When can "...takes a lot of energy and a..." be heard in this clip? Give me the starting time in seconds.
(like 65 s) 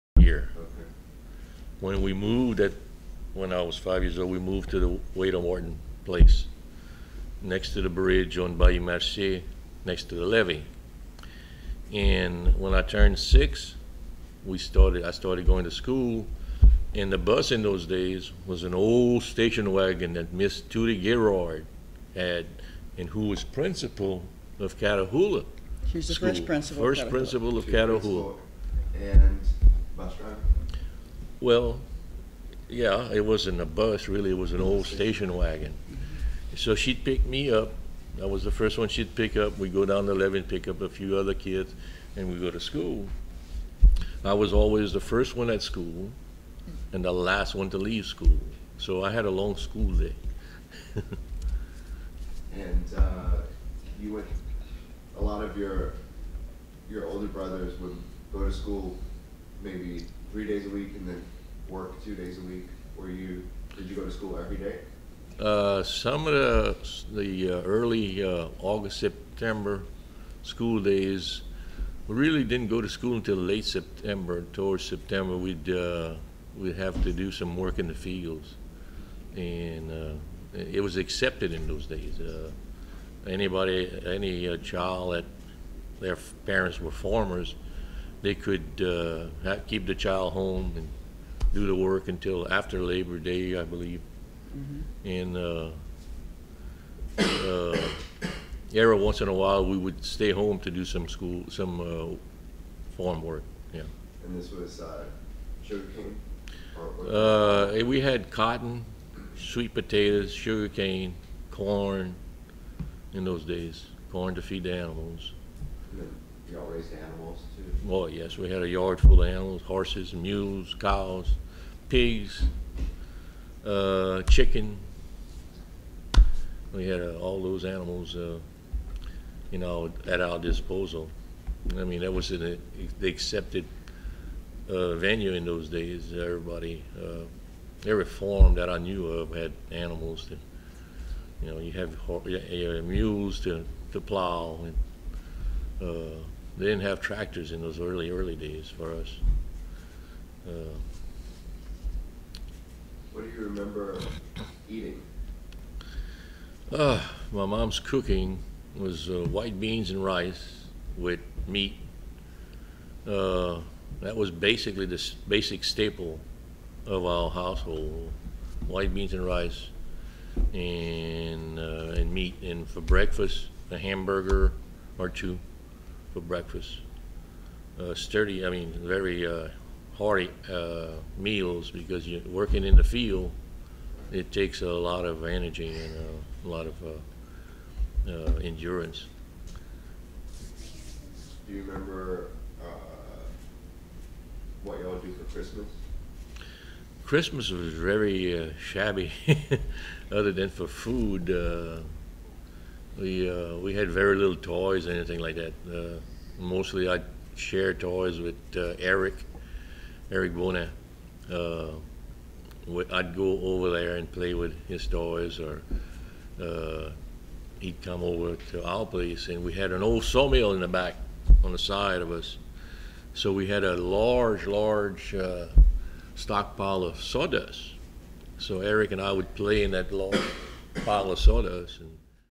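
184 s.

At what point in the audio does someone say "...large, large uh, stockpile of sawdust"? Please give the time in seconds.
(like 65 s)
223 s.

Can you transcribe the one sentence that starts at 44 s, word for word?
I was always the first one at school and the last one to leave school.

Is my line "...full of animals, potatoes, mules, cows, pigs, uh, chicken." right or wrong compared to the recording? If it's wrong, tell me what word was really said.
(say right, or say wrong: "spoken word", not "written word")
wrong: "horses", not "potatoes".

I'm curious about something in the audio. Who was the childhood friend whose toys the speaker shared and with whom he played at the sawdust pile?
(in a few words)
Eric Bona.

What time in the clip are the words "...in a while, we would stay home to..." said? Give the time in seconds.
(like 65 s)
99 s.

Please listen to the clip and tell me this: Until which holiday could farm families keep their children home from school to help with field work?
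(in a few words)
Labor Day.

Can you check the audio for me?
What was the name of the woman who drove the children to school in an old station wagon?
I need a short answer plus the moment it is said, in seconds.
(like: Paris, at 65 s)
Miss Tootie Gerard, at 20 s.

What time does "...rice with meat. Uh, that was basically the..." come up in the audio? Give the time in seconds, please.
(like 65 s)
160 s.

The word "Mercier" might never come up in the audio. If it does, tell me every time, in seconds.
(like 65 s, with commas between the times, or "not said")
8 s.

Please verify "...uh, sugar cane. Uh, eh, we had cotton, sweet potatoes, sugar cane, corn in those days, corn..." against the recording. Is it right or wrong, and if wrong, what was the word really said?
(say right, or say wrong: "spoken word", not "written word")
right.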